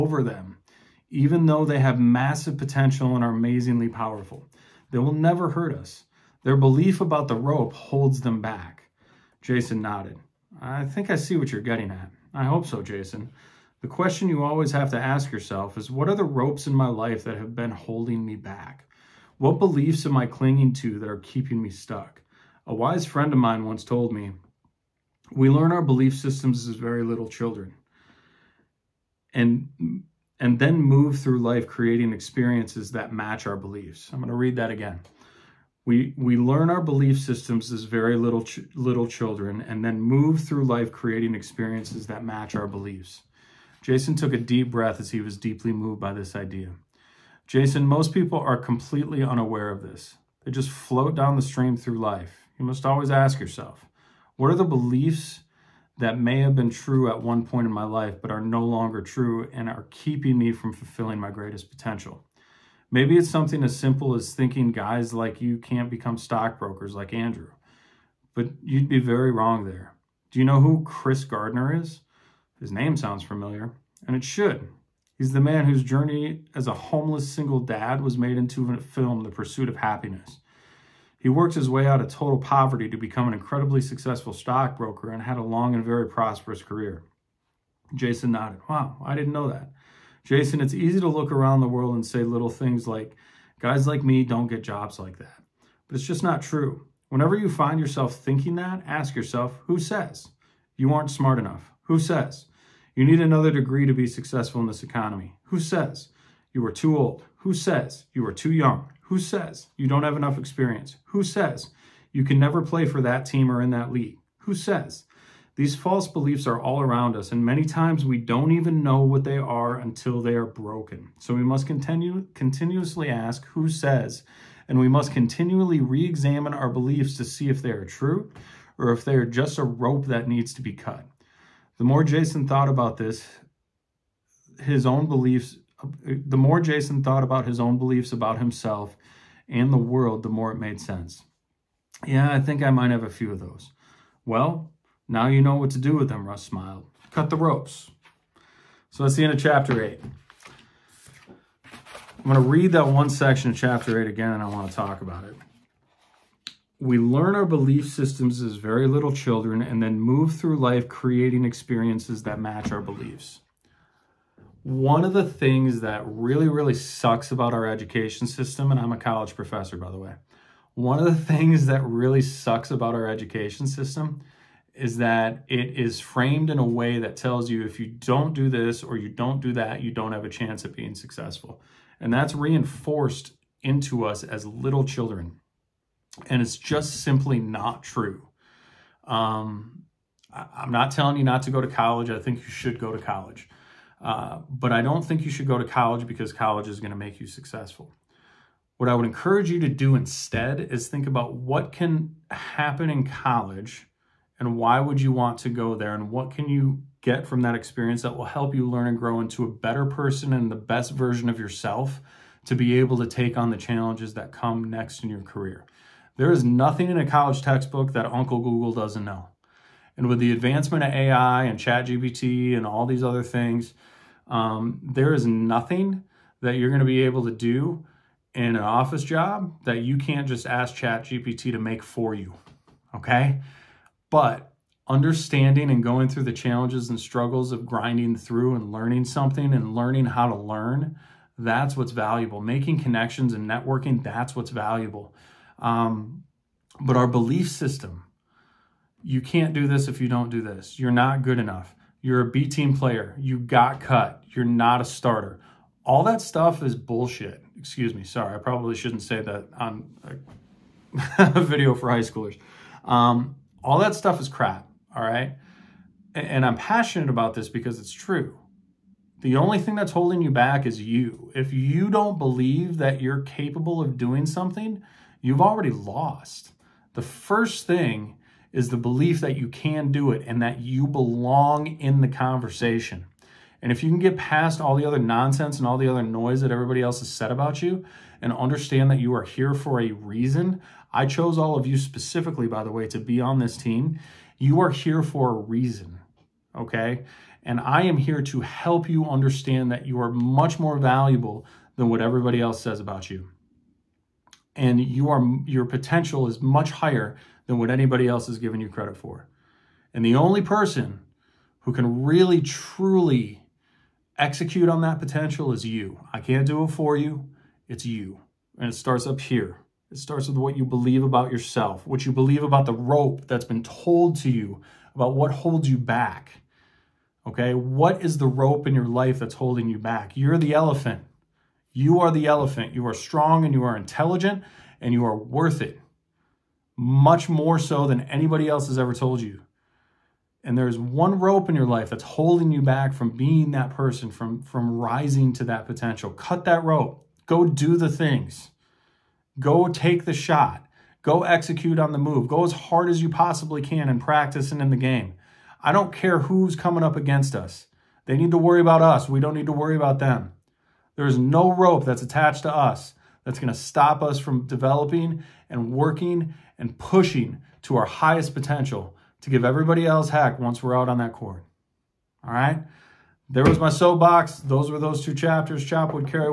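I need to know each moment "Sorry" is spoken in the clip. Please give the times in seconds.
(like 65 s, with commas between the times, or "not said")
258 s.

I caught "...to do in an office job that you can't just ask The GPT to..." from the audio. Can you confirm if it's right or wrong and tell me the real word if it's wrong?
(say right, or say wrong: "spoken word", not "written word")
wrong: "Chat", not "The".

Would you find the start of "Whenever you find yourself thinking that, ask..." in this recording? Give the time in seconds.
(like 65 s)
97 s.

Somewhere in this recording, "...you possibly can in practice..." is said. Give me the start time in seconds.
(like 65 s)
353 s.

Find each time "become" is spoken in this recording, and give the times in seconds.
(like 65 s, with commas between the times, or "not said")
65 s, 82 s.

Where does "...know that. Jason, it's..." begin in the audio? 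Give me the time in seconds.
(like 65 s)
89 s.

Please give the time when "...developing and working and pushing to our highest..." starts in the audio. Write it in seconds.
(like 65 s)
364 s.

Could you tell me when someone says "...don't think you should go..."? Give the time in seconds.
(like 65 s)
194 s.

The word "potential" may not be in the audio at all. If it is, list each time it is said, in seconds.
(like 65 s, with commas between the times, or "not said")
2 s, 61 s, 305 s, 314 s, 345 s, 368 s.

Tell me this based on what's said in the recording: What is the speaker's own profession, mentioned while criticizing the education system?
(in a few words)
College professor.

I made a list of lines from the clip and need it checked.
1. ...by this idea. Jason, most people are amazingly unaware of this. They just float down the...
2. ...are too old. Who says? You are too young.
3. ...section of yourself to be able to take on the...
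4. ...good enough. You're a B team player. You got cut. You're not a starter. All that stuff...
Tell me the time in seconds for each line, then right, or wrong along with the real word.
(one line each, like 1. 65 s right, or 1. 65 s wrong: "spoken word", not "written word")
1. 45 s wrong: "completely", not "amazingly"
2. 106 s right
3. 210 s wrong: "version", not "section"
4. 251 s right.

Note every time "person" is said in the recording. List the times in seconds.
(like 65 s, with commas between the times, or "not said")
209 s, 310 s, 343 s.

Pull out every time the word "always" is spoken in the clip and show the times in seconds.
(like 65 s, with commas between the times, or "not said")
14 s, 52 s.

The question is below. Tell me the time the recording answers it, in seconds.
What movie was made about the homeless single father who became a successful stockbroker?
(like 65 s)
79 s.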